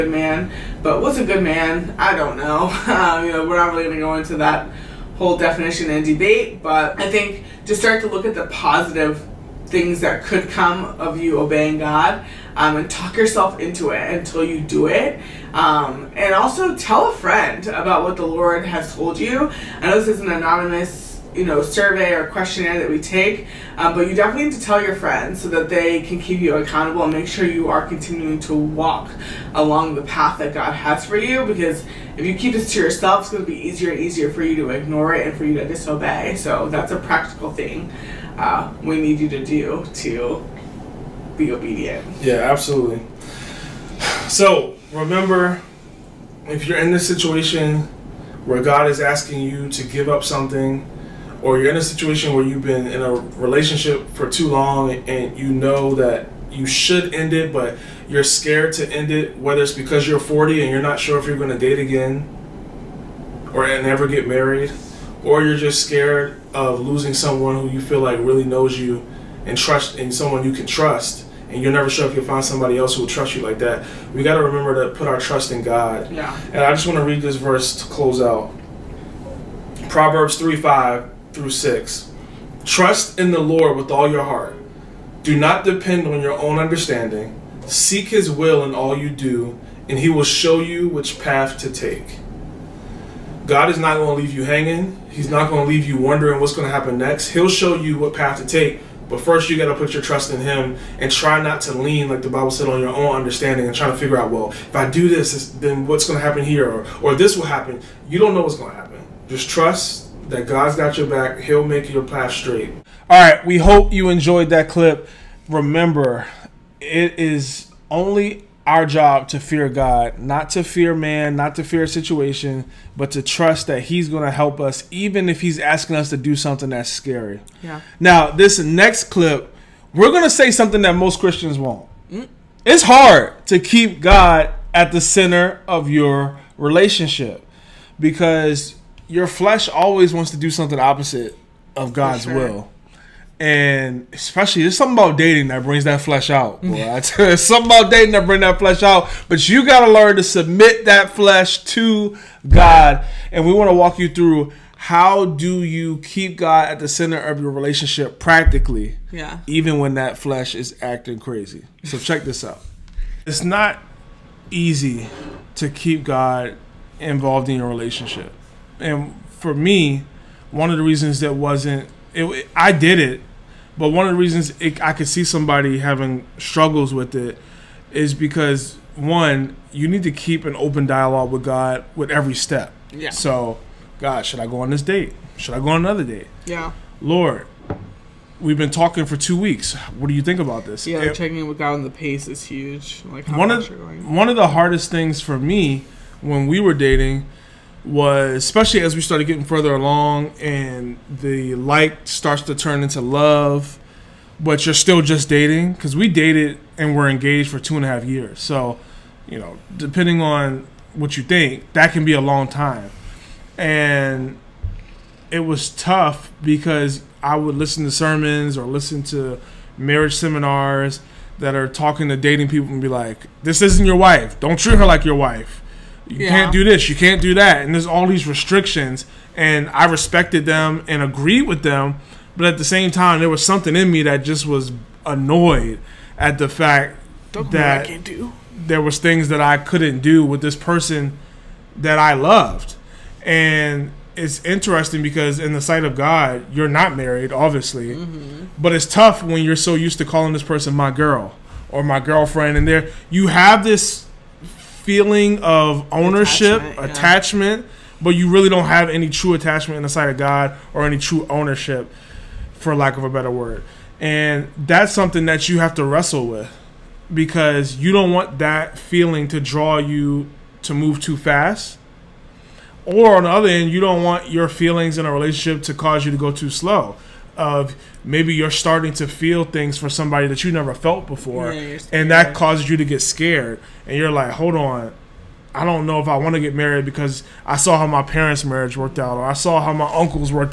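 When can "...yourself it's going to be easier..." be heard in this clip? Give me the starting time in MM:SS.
00:32.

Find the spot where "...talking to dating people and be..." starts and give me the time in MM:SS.
03:41.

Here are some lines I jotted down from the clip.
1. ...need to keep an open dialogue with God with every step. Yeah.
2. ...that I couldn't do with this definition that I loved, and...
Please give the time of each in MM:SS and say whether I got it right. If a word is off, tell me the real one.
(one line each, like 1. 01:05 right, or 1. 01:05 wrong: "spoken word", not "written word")
1. 02:59 right
2. 03:59 wrong: "person", not "definition".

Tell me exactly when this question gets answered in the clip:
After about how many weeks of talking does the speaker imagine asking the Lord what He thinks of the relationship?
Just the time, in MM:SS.
03:09.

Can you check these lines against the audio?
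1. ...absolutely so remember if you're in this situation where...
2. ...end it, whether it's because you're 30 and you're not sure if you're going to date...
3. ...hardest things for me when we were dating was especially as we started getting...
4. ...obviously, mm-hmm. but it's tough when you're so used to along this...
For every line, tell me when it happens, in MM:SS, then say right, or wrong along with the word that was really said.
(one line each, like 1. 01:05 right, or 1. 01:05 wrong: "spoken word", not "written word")
1. 00:42 right
2. 00:58 wrong: "40", not "30"
3. 03:14 right
4. 04:07 wrong: "calling", not "along".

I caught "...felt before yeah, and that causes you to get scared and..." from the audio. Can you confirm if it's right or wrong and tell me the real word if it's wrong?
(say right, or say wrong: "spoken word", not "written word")
right.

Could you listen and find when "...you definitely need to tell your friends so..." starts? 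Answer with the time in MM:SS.
00:24.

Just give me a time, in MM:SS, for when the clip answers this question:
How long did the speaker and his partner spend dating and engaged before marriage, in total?
03:27.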